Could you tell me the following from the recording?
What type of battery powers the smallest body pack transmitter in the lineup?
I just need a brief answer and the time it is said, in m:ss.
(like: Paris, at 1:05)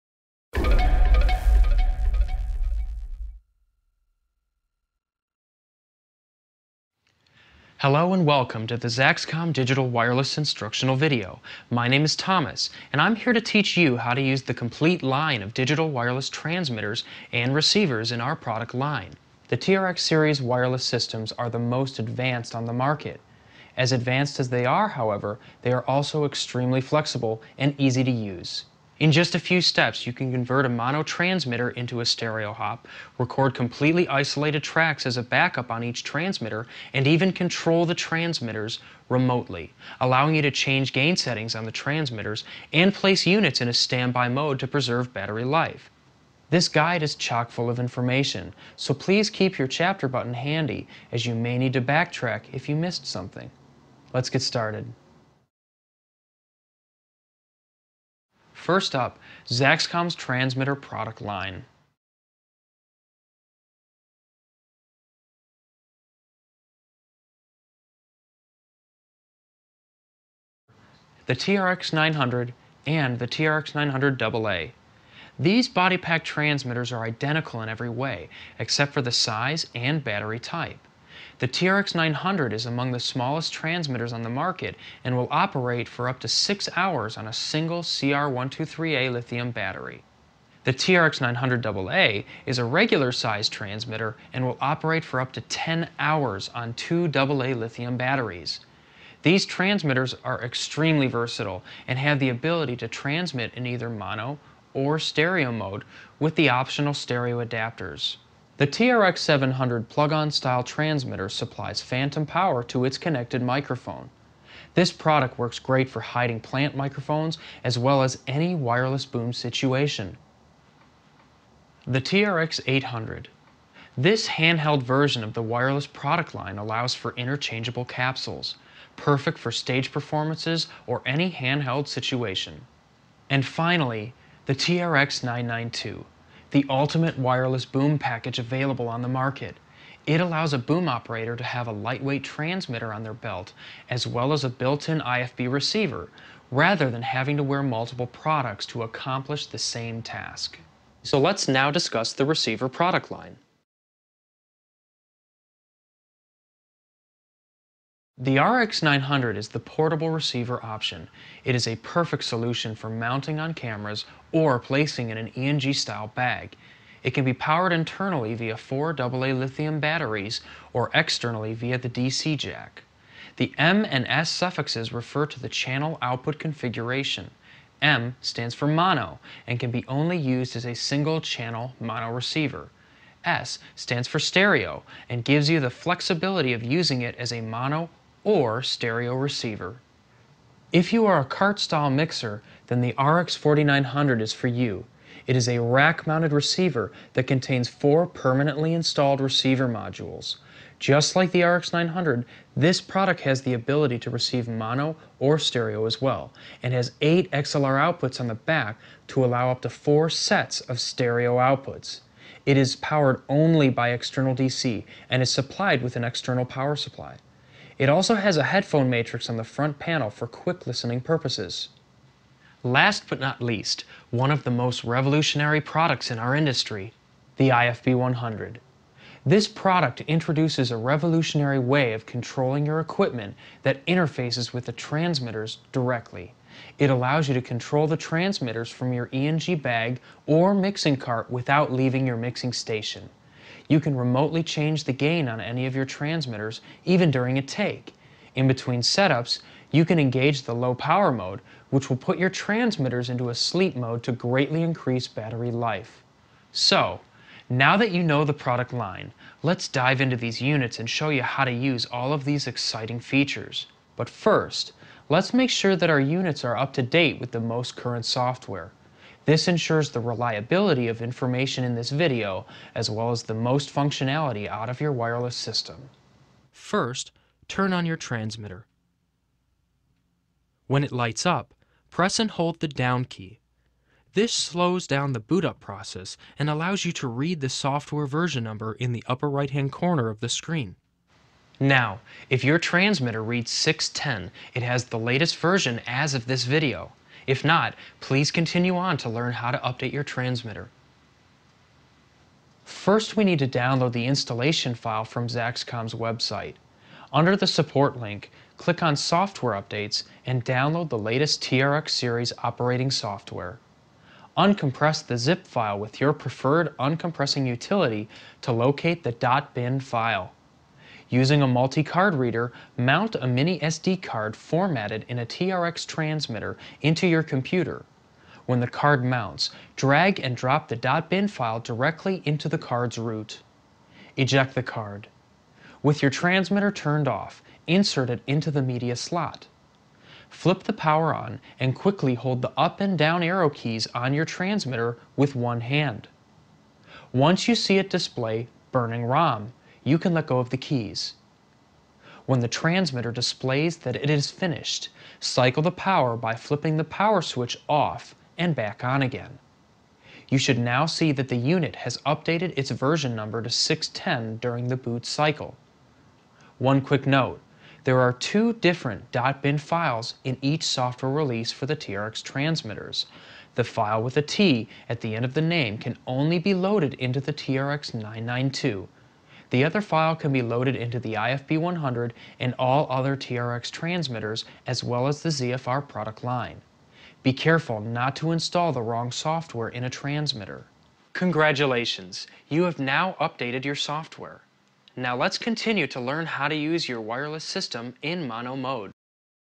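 CR123A, at 1:27.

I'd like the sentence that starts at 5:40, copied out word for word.
Flip the power on and quickly hold the up and down arrow keys on your transmitter with one hand.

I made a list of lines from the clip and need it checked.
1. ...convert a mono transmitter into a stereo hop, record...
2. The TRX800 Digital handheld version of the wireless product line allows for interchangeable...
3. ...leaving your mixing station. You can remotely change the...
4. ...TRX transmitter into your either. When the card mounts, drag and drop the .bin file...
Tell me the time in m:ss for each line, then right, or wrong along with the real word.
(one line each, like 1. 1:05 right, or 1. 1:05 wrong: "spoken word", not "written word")
1. 0:30 right
2. 2:01 wrong: "This", not "Digital"
3. 4:01 right
4. 5:25 wrong: "computer", not "either".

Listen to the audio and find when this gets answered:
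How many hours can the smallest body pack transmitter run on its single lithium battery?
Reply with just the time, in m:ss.
1:26.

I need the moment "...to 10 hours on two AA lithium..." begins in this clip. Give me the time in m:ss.
1:35.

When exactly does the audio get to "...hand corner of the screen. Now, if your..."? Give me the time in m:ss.
4:49.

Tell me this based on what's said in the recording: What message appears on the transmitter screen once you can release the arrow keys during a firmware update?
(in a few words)
Burning ROM.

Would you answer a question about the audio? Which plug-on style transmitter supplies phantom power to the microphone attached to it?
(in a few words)
TRX700.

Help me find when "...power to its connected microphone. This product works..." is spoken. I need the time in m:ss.
1:52.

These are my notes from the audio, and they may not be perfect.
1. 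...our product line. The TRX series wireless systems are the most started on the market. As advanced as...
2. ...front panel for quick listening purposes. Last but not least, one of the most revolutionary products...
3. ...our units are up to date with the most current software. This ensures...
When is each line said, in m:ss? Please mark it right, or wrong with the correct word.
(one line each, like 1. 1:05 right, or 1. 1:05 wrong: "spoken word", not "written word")
1. 0:18 wrong: "advanced", not "started"
2. 3:39 right
3. 4:25 right.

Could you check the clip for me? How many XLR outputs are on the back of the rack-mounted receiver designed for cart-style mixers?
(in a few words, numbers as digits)
8.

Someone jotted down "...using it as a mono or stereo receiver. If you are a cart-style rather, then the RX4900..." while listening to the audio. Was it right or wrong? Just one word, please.
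wrong.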